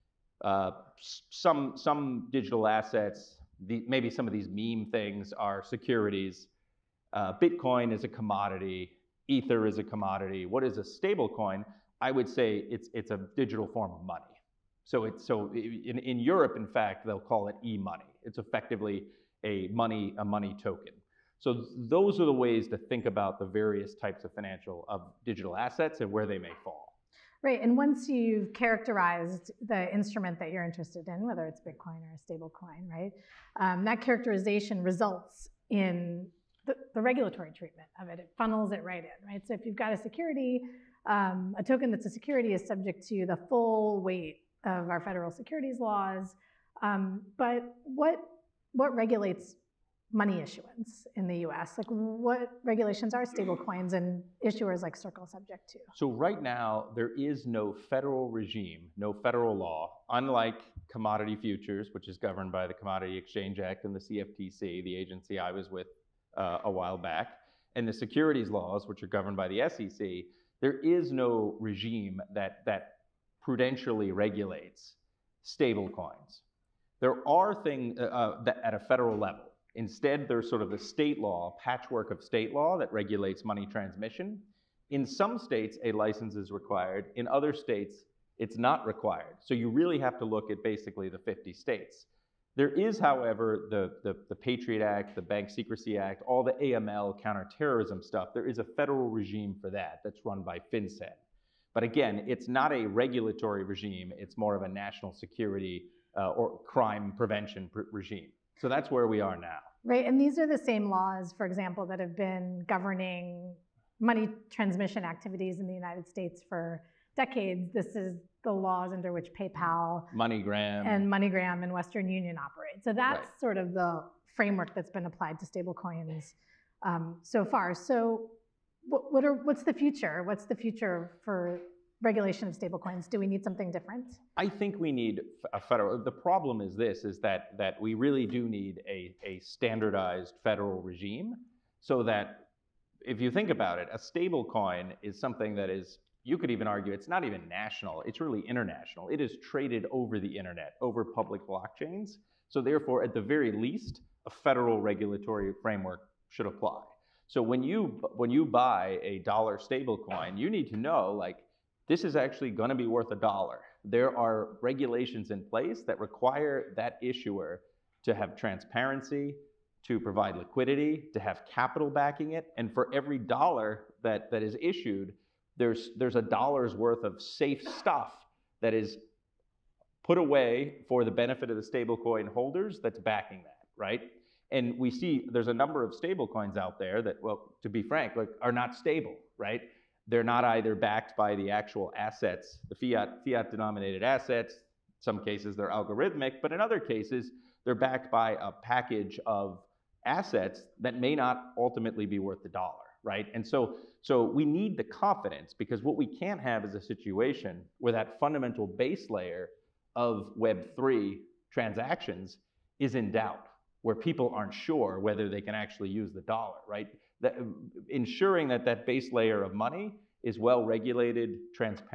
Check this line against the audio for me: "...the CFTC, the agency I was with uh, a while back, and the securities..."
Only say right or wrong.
right.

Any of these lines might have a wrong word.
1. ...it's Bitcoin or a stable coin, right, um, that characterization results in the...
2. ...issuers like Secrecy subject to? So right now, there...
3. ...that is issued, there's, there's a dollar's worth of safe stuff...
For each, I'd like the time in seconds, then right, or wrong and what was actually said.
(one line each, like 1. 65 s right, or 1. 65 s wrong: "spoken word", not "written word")
1. 31 s right
2. 54 s wrong: "Circle", not "Secrecy"
3. 174 s right.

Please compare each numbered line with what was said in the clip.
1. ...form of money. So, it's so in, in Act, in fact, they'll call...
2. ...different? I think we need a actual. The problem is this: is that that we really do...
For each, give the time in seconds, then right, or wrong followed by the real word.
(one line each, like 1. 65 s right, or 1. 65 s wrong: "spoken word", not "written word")
1. 13 s wrong: "Europe", not "Act"
2. 133 s wrong: "federal", not "actual".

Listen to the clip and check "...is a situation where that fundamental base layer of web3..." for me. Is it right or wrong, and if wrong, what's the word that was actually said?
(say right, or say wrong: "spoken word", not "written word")
right.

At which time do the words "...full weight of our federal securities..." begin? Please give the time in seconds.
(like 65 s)
43 s.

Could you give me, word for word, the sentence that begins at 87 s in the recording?
In other states, it's not required.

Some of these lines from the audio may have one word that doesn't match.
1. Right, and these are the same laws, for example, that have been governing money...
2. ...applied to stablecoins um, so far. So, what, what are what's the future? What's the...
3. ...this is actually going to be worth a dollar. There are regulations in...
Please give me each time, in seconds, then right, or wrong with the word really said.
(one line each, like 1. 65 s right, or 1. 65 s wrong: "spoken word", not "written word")
1. 109 s right
2. 125 s right
3. 161 s right.